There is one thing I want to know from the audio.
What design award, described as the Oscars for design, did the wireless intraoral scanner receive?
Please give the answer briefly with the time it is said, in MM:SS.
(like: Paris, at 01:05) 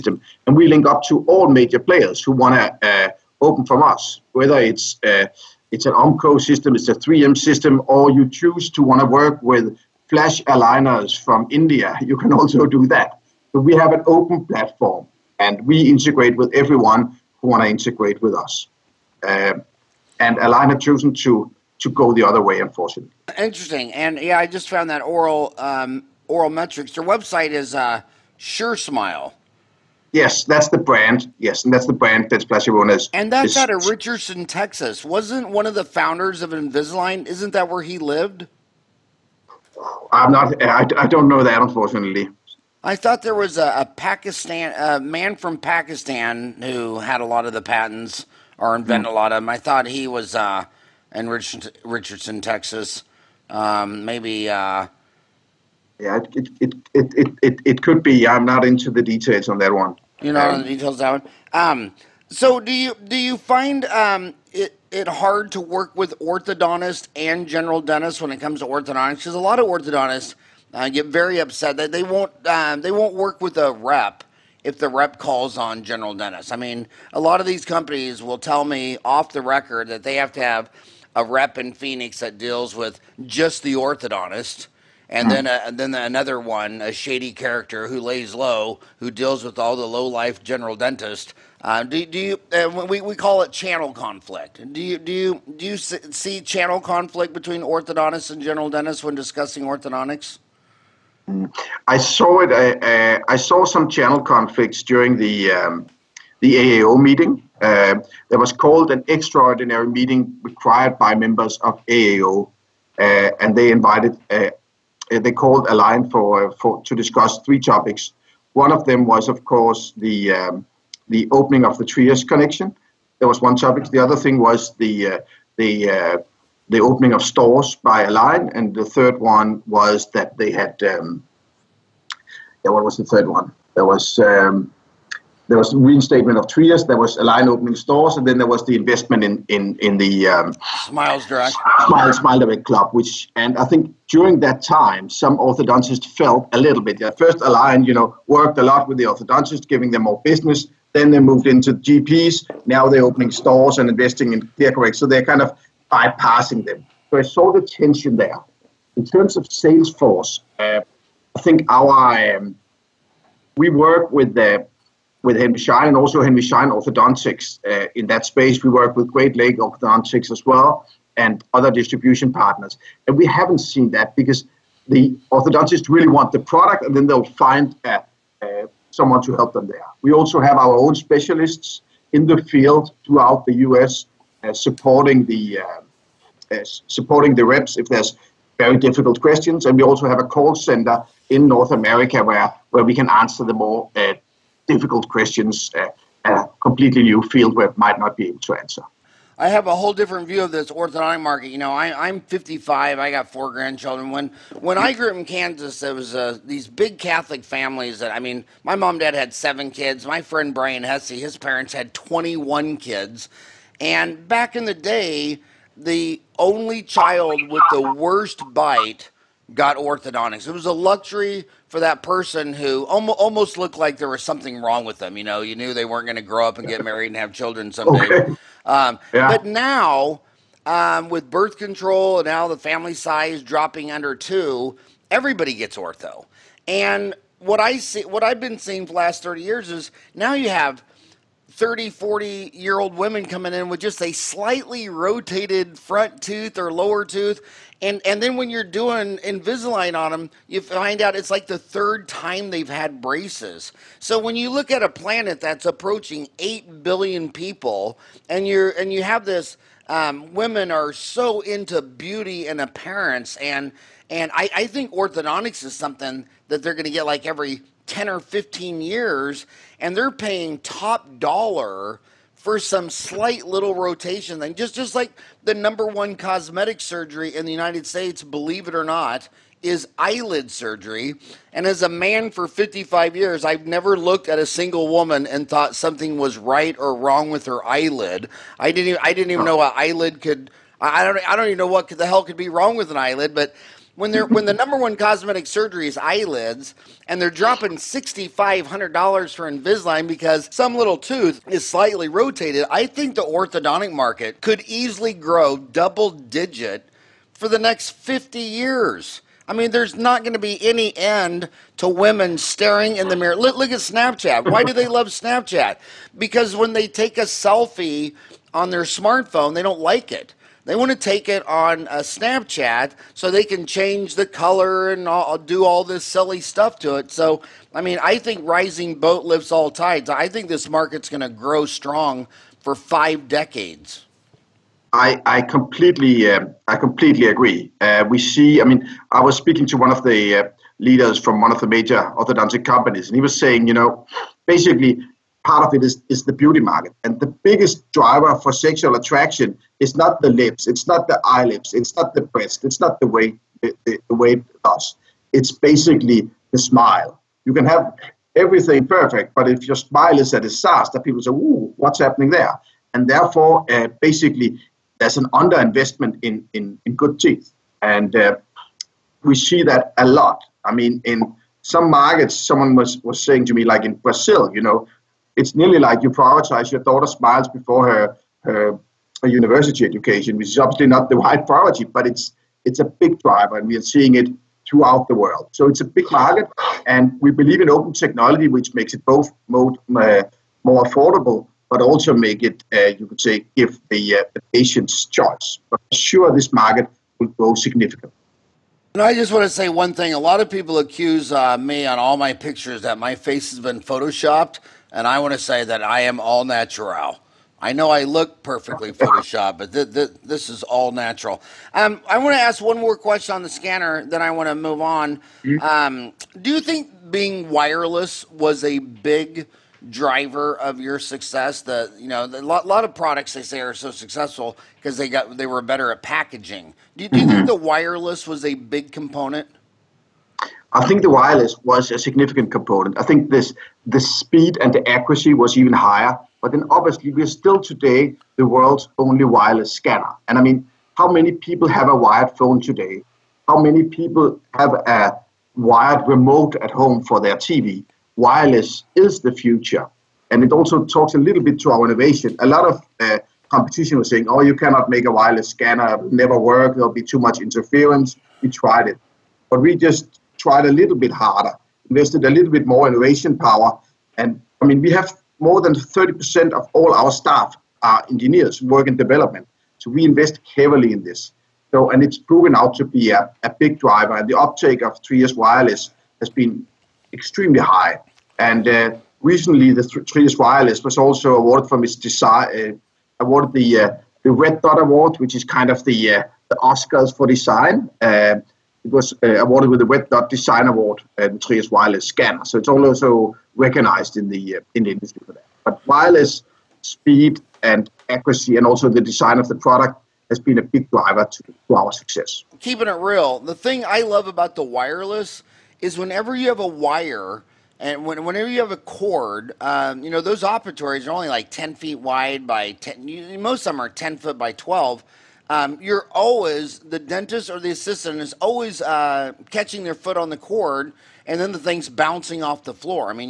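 Red Dot Award, at 08:04.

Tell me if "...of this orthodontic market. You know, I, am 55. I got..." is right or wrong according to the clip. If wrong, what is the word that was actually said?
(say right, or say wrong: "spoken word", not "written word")
right.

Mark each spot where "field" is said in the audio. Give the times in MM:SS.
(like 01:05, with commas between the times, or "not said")
03:02, 03:17.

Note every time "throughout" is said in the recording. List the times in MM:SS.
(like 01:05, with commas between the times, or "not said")
03:03, 06:24.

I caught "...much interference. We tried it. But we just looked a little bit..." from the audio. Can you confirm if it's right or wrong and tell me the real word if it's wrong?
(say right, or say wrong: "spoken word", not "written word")
wrong: "tried", not "looked".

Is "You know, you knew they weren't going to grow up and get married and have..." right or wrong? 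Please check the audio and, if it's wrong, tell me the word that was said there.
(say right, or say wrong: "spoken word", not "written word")
right.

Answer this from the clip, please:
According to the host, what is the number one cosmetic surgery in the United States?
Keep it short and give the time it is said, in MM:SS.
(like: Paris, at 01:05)
eyelid surgery, at 04:39.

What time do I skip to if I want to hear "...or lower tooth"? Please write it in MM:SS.
04:06.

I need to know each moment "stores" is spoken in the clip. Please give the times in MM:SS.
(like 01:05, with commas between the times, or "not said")
02:07, 02:17, 02:33.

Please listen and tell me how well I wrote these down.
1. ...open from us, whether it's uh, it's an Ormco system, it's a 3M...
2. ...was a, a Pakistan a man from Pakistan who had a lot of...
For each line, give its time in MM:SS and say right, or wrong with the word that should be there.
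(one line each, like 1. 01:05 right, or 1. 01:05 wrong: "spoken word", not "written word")
1. 00:03 right
2. 00:43 right.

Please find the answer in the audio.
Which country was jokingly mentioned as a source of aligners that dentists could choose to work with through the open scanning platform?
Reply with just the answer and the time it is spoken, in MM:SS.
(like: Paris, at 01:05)
India, at 00:11.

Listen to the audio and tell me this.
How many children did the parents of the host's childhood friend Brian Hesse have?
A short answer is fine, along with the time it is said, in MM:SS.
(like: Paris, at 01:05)
21, at 03:31.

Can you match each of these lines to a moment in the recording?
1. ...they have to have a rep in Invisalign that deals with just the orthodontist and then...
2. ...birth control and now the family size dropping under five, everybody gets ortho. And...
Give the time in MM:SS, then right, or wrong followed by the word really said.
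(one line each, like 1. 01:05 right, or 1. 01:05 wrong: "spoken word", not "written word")
1. 01:20 wrong: "Phoenix", not "Invisalign"
2. 03:51 wrong: "two", not "five".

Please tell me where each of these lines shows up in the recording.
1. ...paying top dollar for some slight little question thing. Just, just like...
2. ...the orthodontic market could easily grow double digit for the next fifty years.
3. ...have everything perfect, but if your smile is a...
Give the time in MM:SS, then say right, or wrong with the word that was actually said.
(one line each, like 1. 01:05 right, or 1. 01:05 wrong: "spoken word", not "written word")
1. 04:30 wrong: "rotation", not "question"
2. 05:03 right
3. 05:57 right.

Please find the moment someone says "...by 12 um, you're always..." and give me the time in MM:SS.
08:34.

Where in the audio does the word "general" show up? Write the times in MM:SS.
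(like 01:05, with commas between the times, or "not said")
01:07, 01:15, 01:30, 01:38.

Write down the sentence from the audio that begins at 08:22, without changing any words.
Keeping it real, the thing I love about the wireless is whenever you have a wire.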